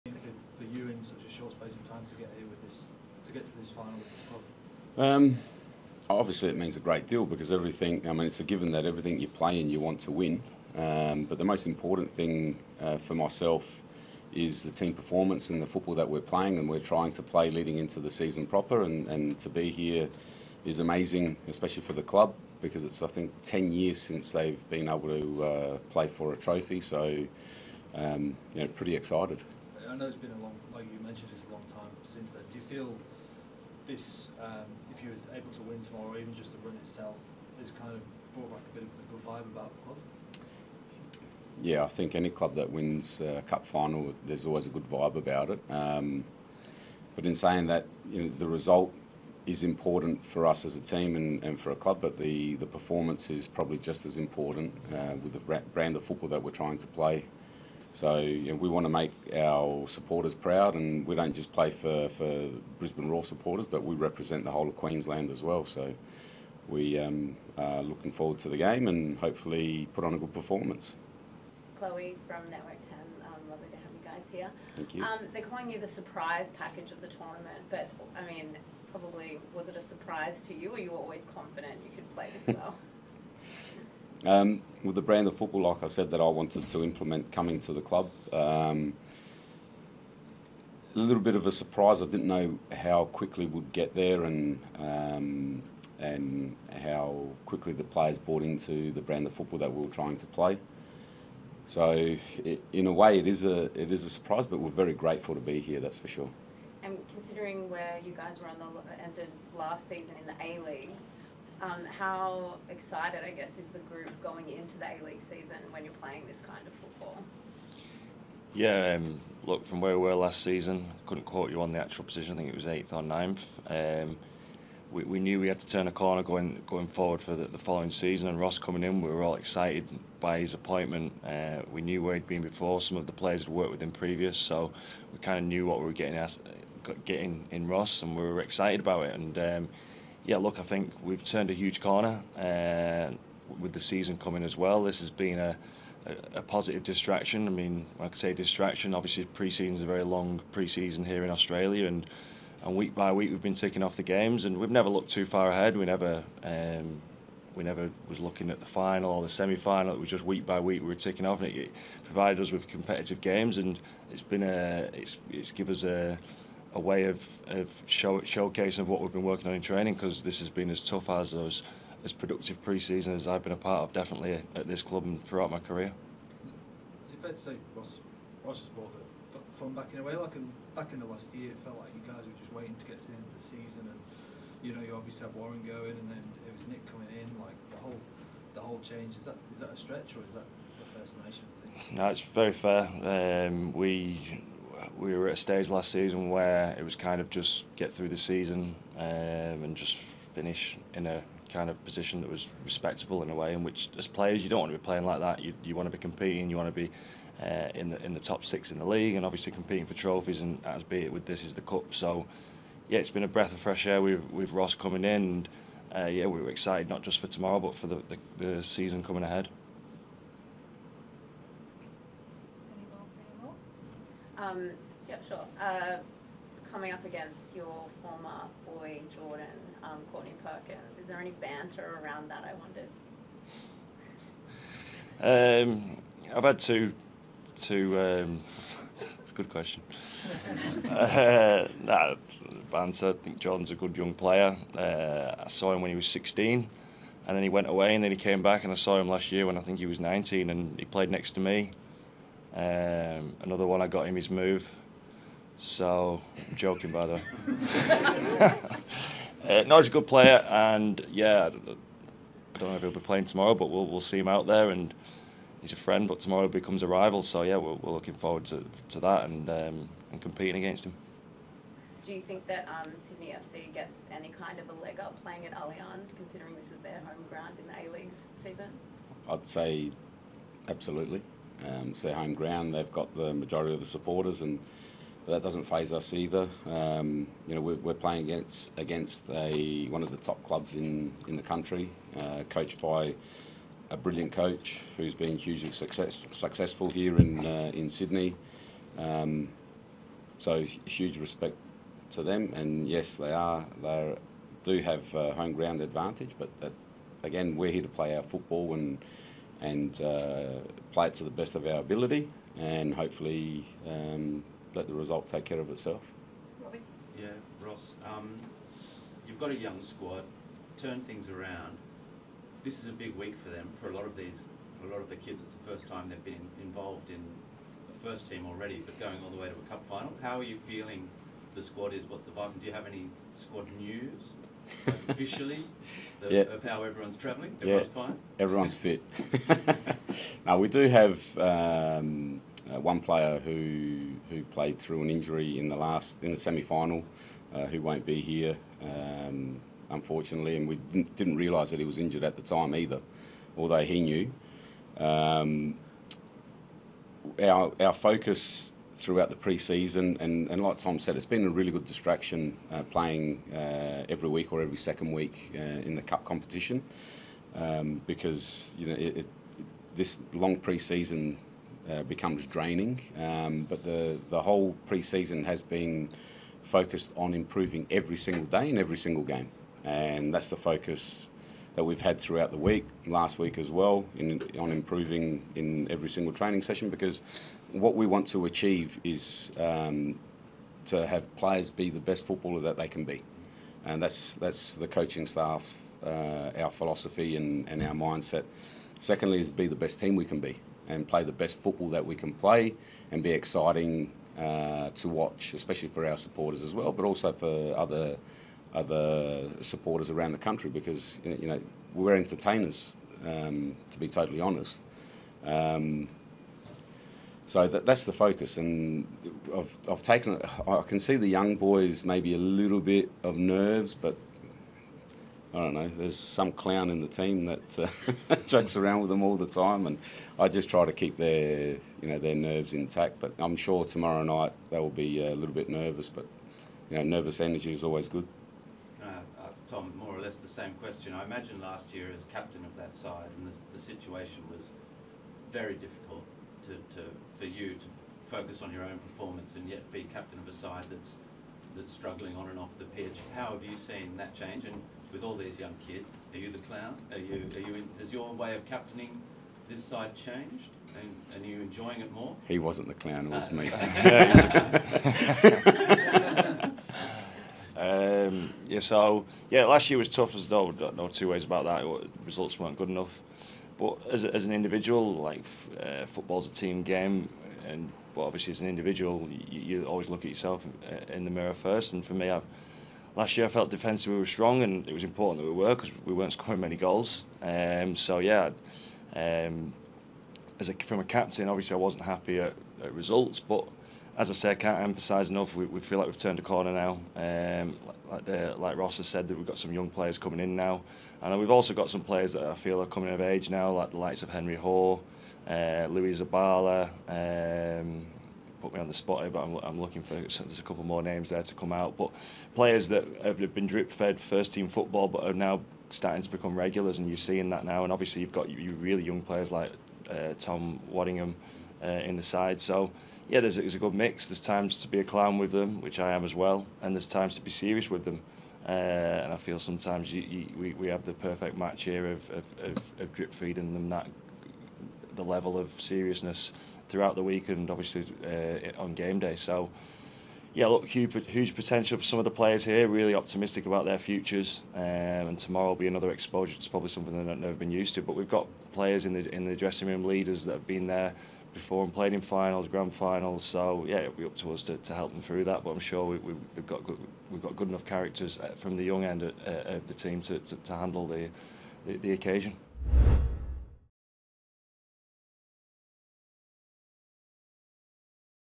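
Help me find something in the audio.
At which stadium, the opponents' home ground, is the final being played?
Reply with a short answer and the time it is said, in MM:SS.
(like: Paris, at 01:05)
Allianz, at 04:35.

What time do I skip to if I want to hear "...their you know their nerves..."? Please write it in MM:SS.
07:11.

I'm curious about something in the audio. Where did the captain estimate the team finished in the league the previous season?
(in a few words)
eighth or ninth.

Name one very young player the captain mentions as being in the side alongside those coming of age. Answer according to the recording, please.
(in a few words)
Tom Waddingham.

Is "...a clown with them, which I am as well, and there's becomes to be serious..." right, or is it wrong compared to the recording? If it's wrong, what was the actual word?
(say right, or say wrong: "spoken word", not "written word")
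wrong: "times", not "becomes".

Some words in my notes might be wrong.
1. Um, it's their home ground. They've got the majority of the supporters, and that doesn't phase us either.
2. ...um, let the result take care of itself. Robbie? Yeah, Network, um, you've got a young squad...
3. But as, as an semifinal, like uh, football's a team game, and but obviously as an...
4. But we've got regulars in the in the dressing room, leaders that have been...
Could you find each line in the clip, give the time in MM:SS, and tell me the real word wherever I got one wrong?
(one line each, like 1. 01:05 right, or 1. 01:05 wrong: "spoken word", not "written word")
1. 04:41 right
2. 05:13 wrong: "Ross", not "Network"
3. 07:53 wrong: "individual", not "semifinal"
4. 09:08 wrong: "players", not "regulars".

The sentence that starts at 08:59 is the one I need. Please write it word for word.
So, yeah, look, huge, huge potential for some of the players here.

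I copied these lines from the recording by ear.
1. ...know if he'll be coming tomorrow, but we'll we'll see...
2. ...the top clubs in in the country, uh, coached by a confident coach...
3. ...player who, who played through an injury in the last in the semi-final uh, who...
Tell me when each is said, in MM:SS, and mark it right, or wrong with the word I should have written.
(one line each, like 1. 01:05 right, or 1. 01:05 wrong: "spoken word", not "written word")
1. 04:22 wrong: "playing", not "coming"
2. 04:50 wrong: "brilliant", not "confident"
3. 05:42 right.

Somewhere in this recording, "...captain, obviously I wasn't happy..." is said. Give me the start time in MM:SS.
08:11.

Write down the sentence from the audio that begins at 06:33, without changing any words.
And that's, that's the coaching staff, uh, our philosophy and, and our mindset.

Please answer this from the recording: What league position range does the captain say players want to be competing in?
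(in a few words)
top six.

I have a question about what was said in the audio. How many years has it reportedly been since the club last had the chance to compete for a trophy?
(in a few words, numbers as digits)
10.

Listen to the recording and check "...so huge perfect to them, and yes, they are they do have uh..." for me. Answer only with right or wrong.
wrong.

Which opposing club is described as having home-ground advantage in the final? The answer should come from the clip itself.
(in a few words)
Sydney FC.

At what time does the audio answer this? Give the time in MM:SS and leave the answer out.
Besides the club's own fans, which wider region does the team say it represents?
01:04.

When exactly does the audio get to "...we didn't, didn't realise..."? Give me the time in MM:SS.
05:50.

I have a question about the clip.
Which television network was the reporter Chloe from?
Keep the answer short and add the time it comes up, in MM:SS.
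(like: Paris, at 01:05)
Network 10, at 01:12.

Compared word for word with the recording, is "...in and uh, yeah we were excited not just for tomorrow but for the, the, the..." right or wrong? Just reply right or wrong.
right.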